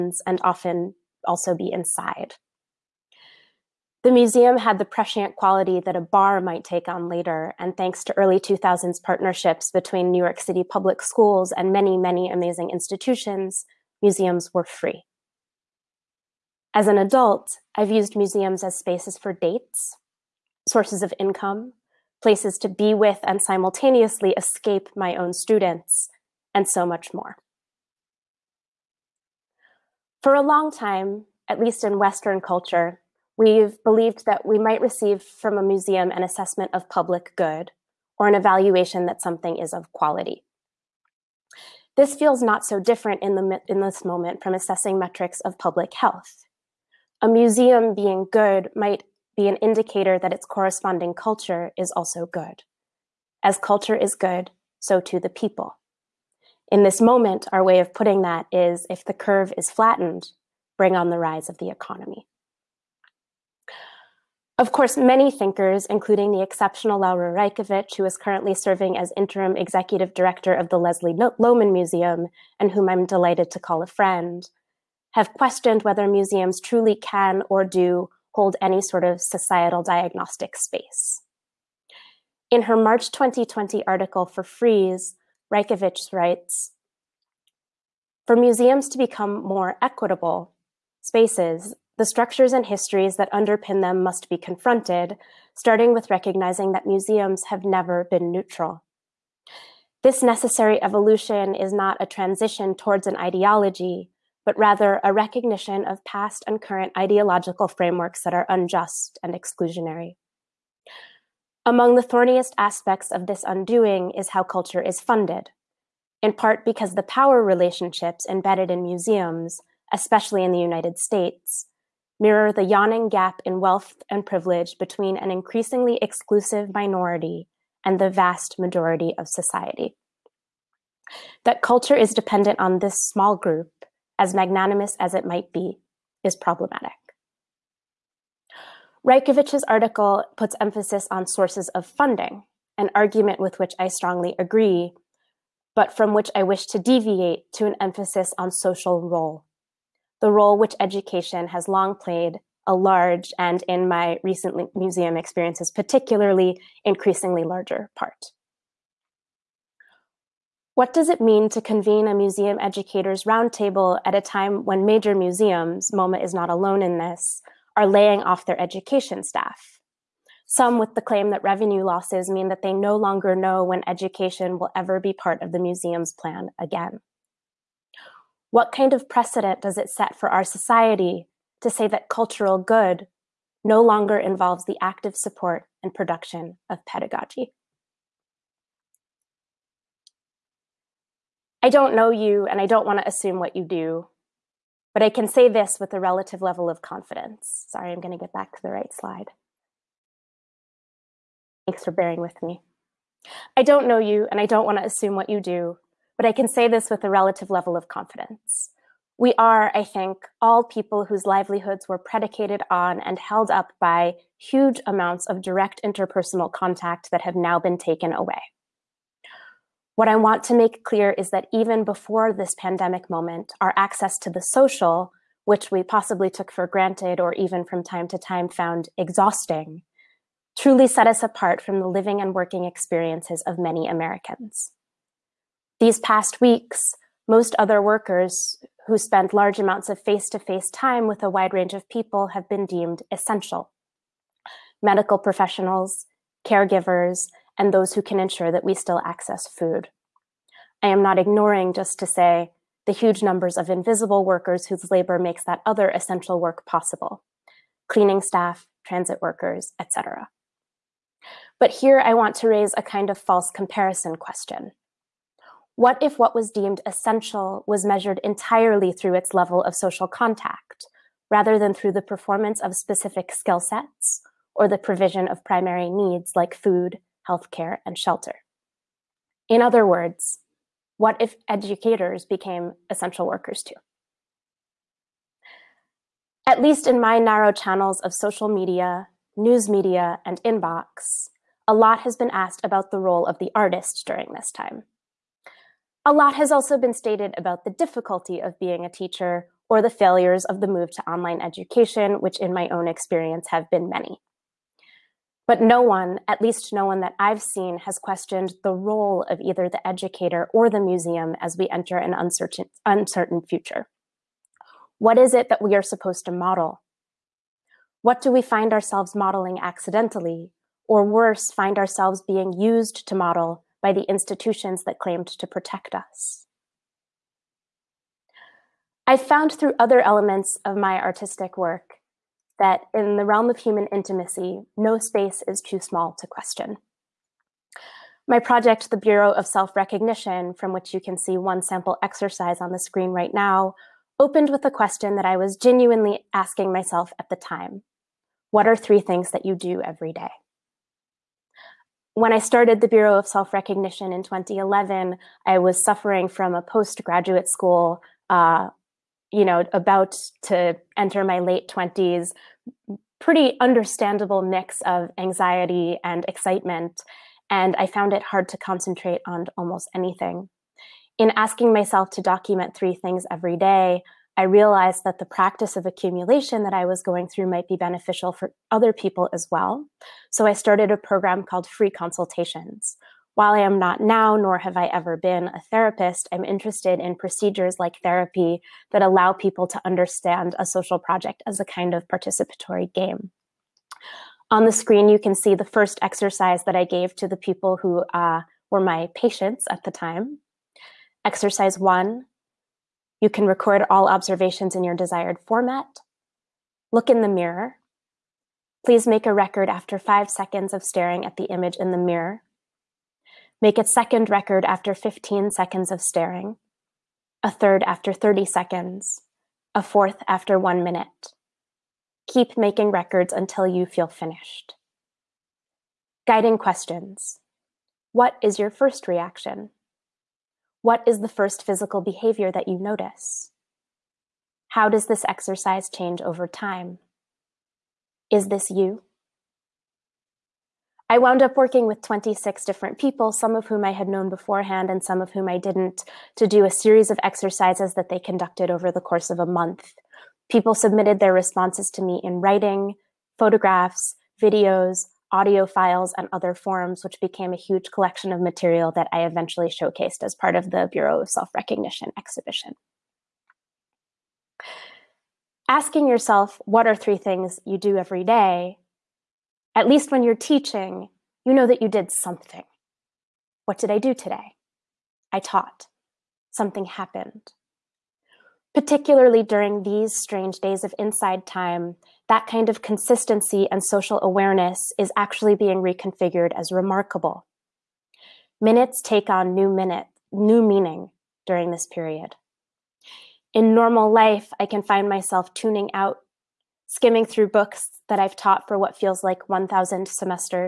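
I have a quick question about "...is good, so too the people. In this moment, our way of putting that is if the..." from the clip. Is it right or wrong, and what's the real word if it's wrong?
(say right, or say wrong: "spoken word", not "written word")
right.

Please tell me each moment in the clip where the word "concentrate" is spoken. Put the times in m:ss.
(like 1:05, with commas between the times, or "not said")
6:08.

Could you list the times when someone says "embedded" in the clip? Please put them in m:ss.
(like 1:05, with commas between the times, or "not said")
1:58.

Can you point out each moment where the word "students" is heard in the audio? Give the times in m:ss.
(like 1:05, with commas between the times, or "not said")
0:25.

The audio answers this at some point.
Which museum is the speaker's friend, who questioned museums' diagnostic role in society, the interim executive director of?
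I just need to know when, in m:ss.
1:10.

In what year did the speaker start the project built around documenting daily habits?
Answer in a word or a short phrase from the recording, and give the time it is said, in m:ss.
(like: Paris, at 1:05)
2011, at 5:54.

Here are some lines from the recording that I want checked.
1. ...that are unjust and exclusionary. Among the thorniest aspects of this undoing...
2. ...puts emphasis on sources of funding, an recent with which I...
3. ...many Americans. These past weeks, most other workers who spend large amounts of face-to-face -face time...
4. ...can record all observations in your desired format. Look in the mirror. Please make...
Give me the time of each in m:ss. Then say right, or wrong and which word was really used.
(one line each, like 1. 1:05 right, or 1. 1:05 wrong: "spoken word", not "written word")
1. 1:48 right
2. 2:20 wrong: "argument", not "recent"
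3. 3:53 right
4. 6:43 right.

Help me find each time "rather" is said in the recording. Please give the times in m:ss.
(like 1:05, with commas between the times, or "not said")
1:44, 4:31.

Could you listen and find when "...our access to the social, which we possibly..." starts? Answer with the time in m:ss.
3:43.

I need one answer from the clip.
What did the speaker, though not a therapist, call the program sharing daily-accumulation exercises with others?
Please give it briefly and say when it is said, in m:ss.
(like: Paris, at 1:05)
Free Consultations, at 6:21.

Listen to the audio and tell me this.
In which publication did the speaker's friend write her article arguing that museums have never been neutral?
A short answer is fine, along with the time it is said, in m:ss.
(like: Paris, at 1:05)
Frieze, at 1:24.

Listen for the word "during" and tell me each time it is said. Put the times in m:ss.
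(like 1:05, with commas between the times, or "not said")
4:54, 7:59, 8:11.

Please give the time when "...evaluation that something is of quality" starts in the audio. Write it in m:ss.
0:38.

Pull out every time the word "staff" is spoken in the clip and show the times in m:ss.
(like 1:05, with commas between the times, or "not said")
2:49, 4:18.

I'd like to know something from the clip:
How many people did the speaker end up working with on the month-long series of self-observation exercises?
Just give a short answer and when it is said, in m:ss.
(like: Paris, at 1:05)
26, at 7:22.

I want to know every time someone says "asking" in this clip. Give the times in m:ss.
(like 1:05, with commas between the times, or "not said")
5:46, 6:11, 7:45.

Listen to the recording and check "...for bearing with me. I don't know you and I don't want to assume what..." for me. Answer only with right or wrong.
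right.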